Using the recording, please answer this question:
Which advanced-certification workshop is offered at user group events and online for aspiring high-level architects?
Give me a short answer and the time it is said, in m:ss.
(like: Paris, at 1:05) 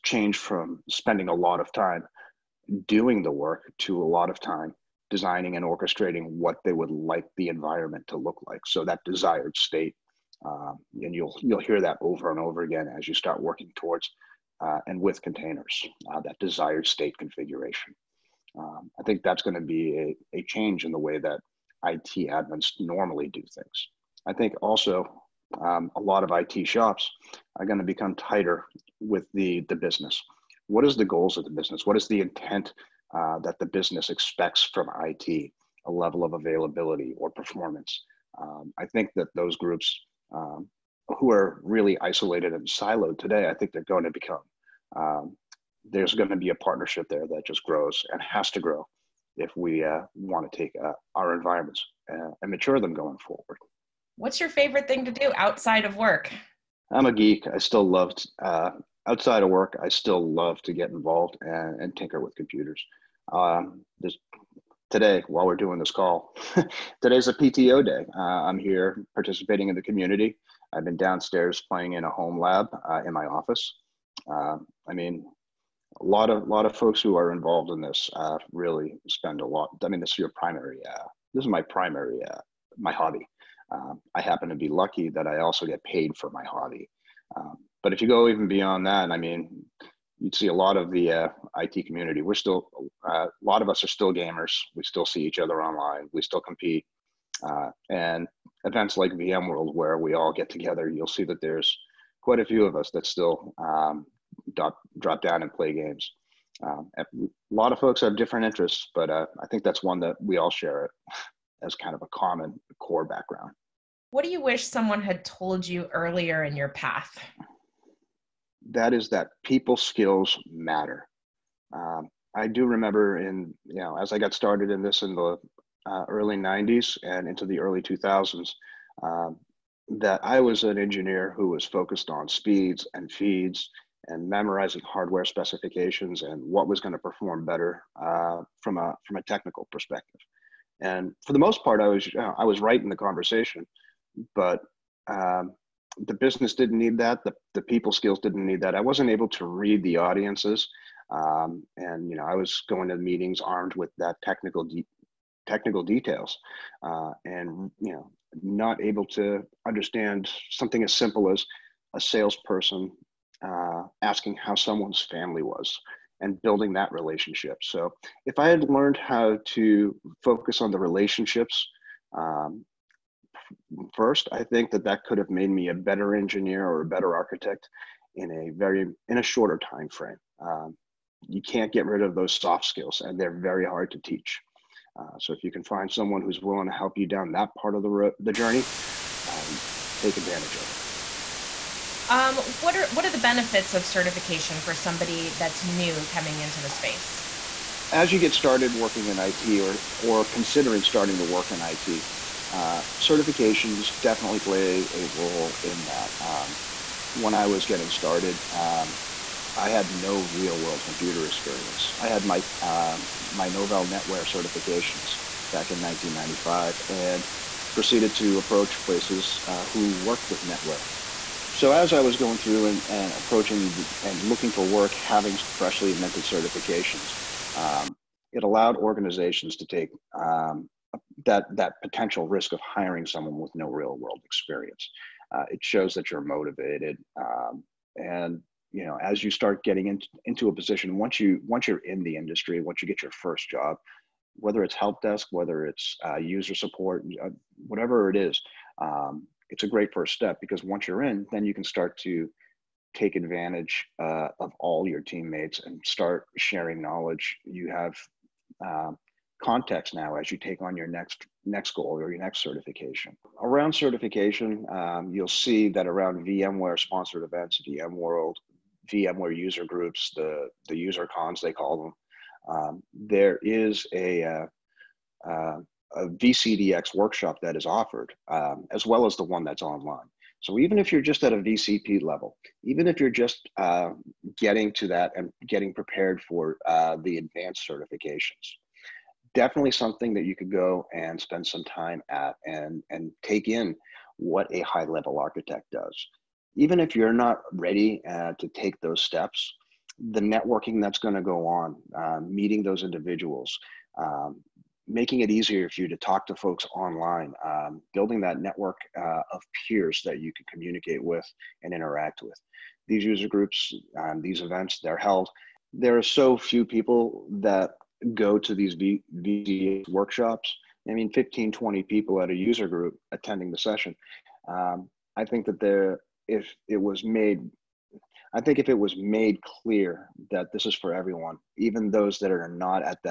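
VCDX workshop, at 4:36.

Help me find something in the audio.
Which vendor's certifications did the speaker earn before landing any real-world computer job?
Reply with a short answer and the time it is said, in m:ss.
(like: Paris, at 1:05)
Novell NetWare, at 3:33.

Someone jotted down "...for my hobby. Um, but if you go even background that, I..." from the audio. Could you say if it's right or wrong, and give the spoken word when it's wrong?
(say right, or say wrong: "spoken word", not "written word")
wrong: "beyond", not "background".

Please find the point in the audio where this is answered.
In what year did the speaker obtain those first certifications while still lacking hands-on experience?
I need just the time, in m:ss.
3:35.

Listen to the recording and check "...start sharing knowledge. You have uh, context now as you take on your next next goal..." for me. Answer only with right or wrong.
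right.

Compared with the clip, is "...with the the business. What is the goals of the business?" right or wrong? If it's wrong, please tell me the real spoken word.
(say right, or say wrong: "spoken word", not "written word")
right.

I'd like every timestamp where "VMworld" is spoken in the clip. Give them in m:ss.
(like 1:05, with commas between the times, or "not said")
1:39, 4:27.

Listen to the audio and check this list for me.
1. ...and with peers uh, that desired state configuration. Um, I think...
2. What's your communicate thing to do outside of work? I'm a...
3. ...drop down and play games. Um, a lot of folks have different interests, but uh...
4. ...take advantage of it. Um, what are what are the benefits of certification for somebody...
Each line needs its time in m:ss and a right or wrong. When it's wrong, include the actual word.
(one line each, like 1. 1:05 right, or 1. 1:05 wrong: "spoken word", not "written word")
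1. 0:14 wrong: "containers", not "peers"
2. 0:54 wrong: "favorite", not "communicate"
3. 1:44 right
4. 3:09 right.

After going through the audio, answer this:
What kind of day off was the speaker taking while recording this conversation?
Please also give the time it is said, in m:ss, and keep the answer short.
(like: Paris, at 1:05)
PTO day, at 1:07.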